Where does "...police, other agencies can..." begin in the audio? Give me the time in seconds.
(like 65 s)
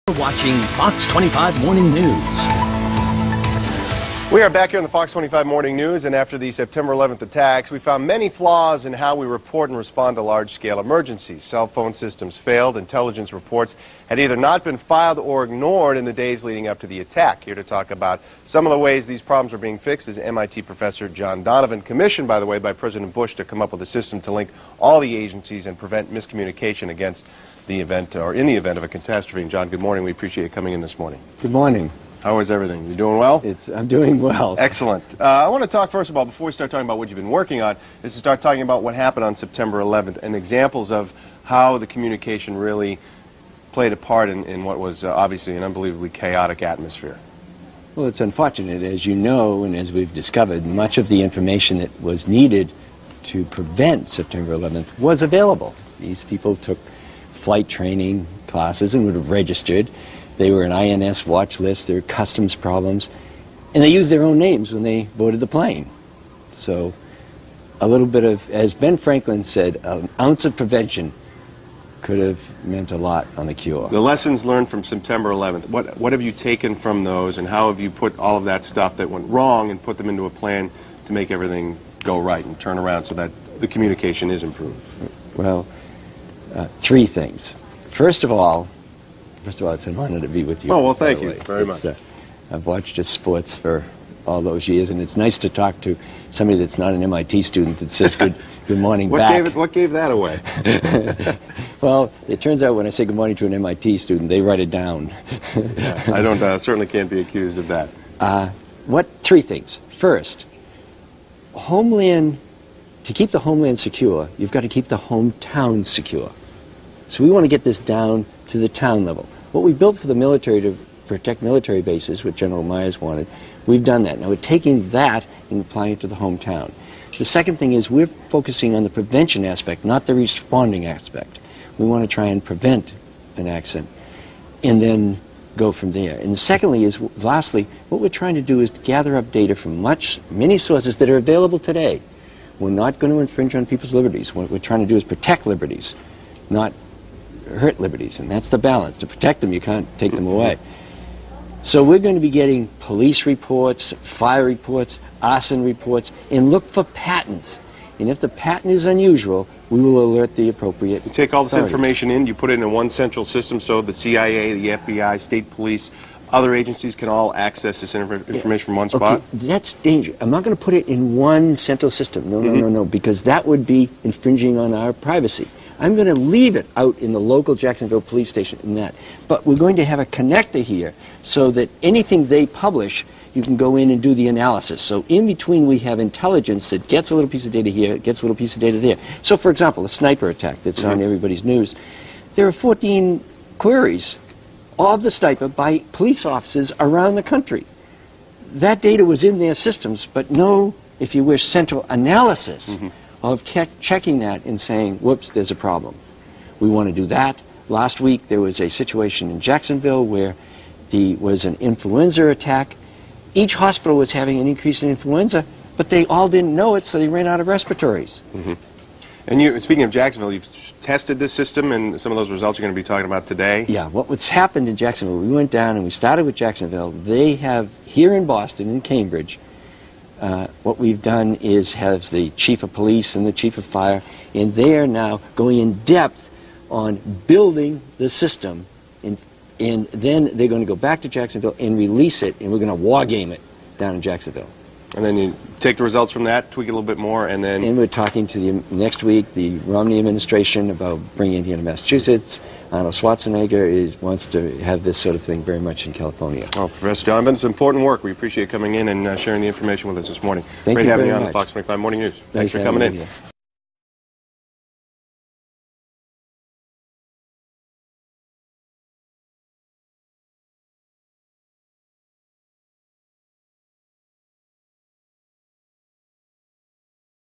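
165 s.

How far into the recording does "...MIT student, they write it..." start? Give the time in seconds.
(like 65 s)
103 s.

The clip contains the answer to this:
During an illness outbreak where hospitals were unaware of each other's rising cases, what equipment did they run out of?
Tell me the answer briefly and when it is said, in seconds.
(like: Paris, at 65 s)
respirators, at 217 s.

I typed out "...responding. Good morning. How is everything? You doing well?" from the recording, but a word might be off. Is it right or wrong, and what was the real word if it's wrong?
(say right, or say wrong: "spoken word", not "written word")
wrong: "morning", not "responding".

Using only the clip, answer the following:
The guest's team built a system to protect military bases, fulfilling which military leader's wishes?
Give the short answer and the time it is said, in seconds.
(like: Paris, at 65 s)
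General Myers, at 122 s.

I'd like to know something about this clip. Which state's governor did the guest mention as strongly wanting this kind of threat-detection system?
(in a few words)
California.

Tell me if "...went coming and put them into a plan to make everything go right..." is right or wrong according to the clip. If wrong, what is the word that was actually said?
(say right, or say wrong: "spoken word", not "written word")
wrong: "wrong", not "coming".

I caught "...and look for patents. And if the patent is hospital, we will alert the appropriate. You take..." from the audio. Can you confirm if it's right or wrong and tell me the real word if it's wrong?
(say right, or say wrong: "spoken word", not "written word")
wrong: "unusual", not "hospital".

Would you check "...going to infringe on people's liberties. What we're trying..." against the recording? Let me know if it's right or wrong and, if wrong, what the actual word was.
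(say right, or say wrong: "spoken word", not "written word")
right.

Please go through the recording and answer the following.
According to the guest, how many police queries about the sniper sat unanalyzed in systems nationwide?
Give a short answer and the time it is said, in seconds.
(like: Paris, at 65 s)
14, at 192 s.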